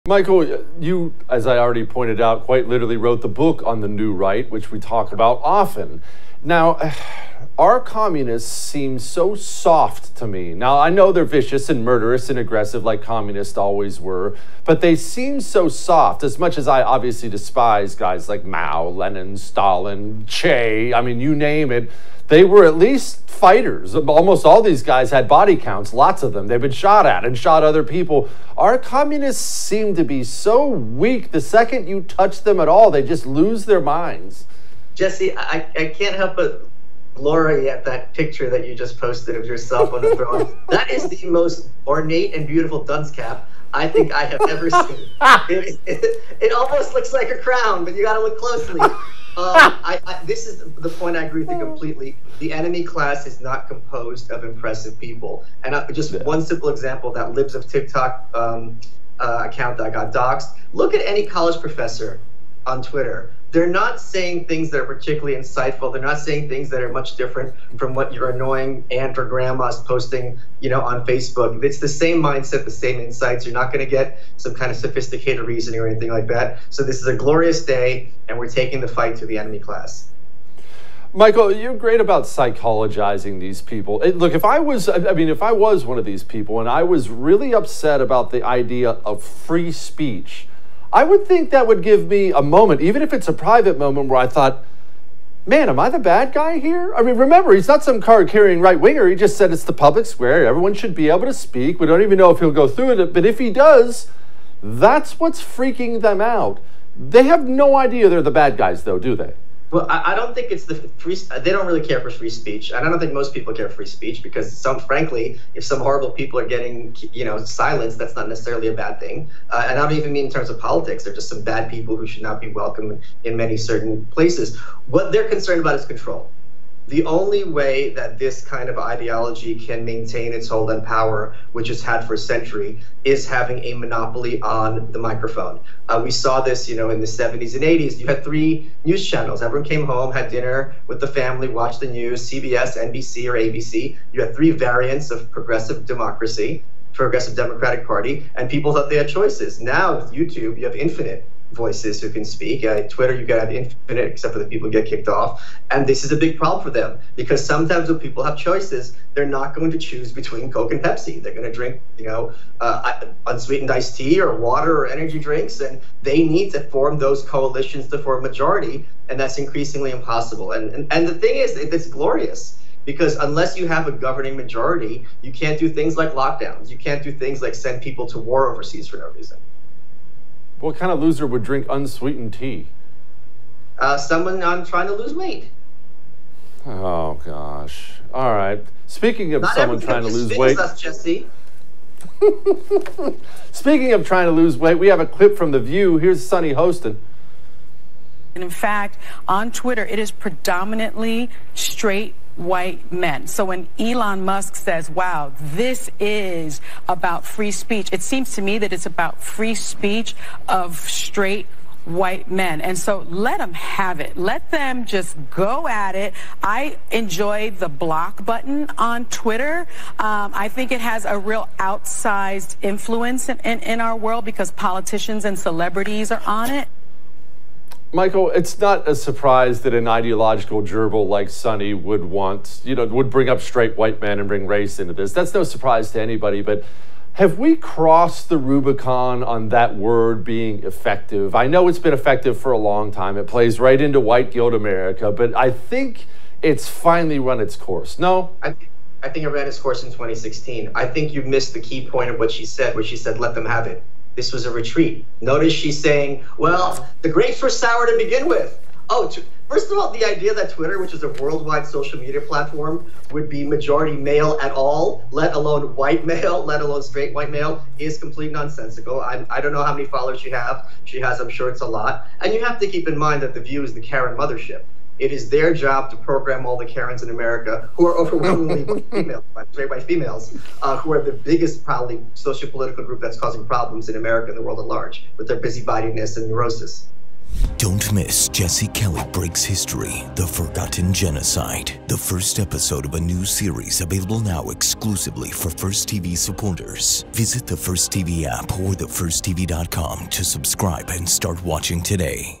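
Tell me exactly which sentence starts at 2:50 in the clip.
And and, and the thing is, it's glorious because unless you have a governing majority, you can't do things like lockdowns.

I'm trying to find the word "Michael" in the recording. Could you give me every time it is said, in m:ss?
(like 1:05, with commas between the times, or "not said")
0:00, 1:21, 3:47.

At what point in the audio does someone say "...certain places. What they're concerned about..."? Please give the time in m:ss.
2:03.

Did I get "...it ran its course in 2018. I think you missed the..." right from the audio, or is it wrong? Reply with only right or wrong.
wrong.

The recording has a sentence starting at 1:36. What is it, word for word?
I mean, remember, he's not some card carrying right winger.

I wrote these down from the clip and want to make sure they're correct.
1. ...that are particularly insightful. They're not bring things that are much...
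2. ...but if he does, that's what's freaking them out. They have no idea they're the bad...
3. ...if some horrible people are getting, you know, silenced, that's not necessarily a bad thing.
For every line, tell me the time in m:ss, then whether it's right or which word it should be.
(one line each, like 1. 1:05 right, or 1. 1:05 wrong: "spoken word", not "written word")
1. 1:04 wrong: "saying", not "bring"
2. 1:43 right
3. 1:55 right.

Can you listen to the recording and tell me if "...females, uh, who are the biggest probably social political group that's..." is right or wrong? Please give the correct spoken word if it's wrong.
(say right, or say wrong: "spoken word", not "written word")
right.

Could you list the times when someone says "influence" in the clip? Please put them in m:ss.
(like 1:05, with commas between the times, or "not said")
3:42.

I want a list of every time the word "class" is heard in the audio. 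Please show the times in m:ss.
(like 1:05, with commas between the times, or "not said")
0:52, 1:19.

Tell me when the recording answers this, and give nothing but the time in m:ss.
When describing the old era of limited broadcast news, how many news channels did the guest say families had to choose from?
2:18.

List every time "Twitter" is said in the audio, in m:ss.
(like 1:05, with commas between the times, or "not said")
1:02, 2:32, 3:19, 3:39, 4:20.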